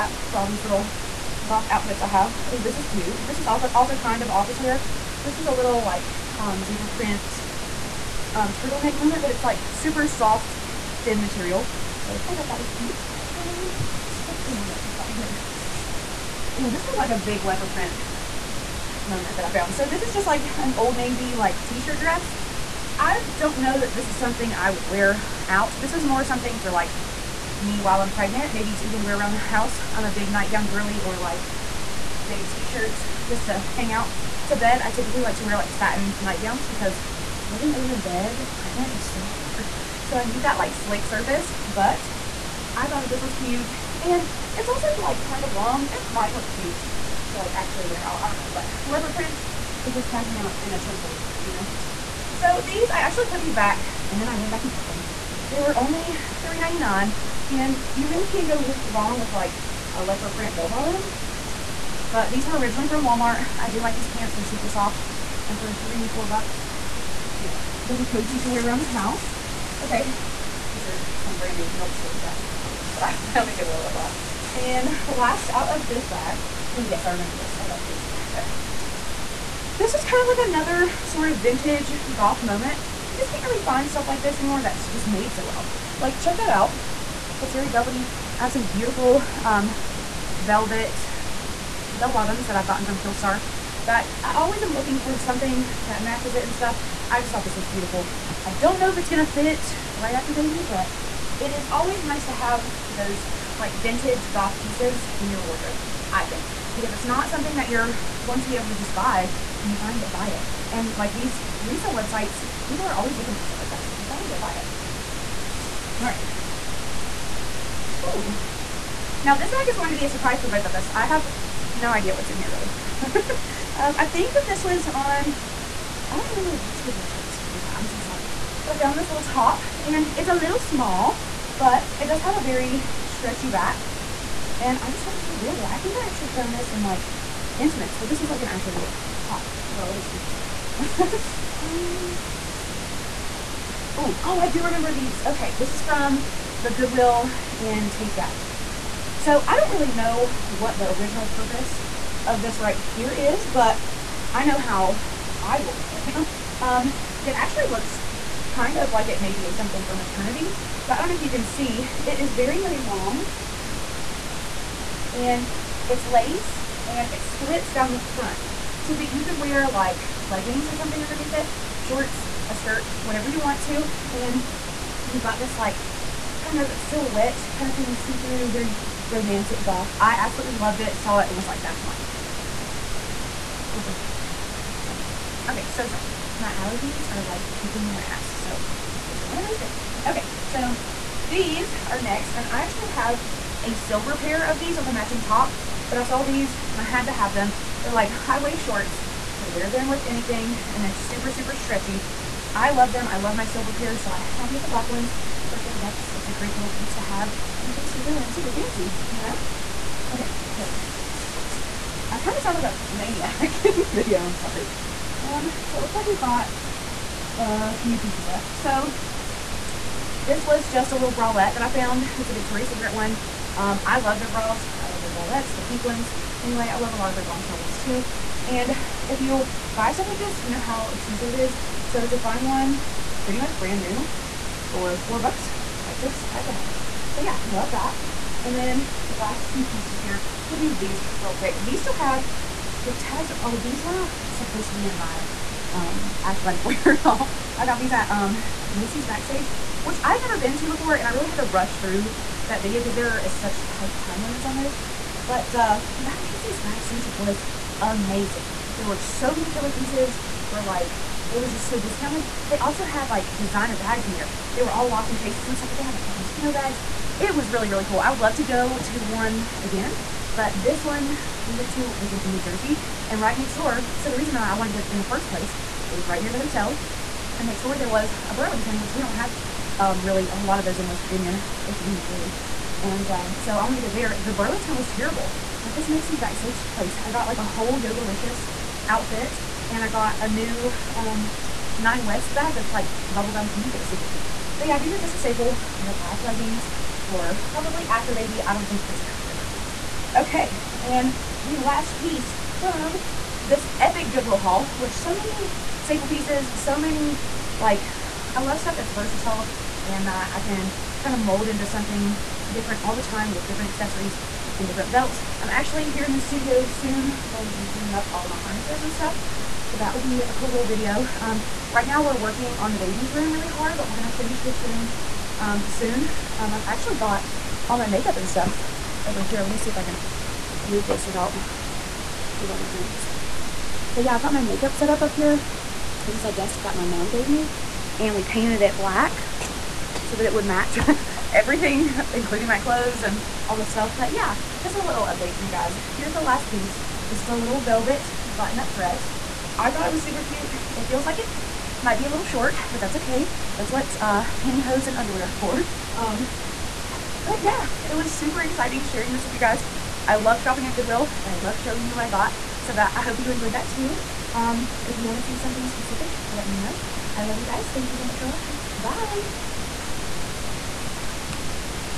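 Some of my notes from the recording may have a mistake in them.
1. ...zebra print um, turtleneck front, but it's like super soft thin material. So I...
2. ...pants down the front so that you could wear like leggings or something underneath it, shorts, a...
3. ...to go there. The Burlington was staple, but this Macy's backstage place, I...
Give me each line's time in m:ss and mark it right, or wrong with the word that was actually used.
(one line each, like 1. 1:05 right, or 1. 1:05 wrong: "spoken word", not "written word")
1. 0:06 wrong: "moment", not "front"
2. 2:47 wrong: "splits", not "pants"
3. 4:43 wrong: "terrible", not "staple".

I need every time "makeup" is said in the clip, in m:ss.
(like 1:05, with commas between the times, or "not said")
5:27, 5:34.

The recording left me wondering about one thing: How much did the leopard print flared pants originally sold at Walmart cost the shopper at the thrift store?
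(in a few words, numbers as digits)
$3.99.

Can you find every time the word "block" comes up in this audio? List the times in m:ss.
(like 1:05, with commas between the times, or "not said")
1:13.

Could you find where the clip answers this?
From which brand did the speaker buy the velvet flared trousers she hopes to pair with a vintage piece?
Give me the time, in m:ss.
1:32.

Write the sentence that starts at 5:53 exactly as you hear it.
That's what uh, pantyhose and underwear are for.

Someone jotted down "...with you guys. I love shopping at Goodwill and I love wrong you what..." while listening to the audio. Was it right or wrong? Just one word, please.
wrong.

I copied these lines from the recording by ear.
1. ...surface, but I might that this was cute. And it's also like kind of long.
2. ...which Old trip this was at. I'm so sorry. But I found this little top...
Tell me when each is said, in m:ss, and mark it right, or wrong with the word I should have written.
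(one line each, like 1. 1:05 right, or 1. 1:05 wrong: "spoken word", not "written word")
1. 0:41 wrong: "thought", not "might"
2. 2:06 wrong: "Goodwill", not "Old".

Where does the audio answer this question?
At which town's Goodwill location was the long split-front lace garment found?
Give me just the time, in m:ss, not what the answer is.
2:27.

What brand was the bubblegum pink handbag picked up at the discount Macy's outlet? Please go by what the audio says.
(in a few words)
Nine West.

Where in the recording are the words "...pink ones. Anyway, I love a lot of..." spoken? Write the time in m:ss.
3:45.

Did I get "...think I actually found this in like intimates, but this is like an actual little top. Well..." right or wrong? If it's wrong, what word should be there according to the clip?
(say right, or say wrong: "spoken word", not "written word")
right.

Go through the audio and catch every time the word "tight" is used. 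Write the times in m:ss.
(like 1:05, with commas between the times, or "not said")
4:13.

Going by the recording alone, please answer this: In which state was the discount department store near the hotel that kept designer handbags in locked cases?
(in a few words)
New Jersey.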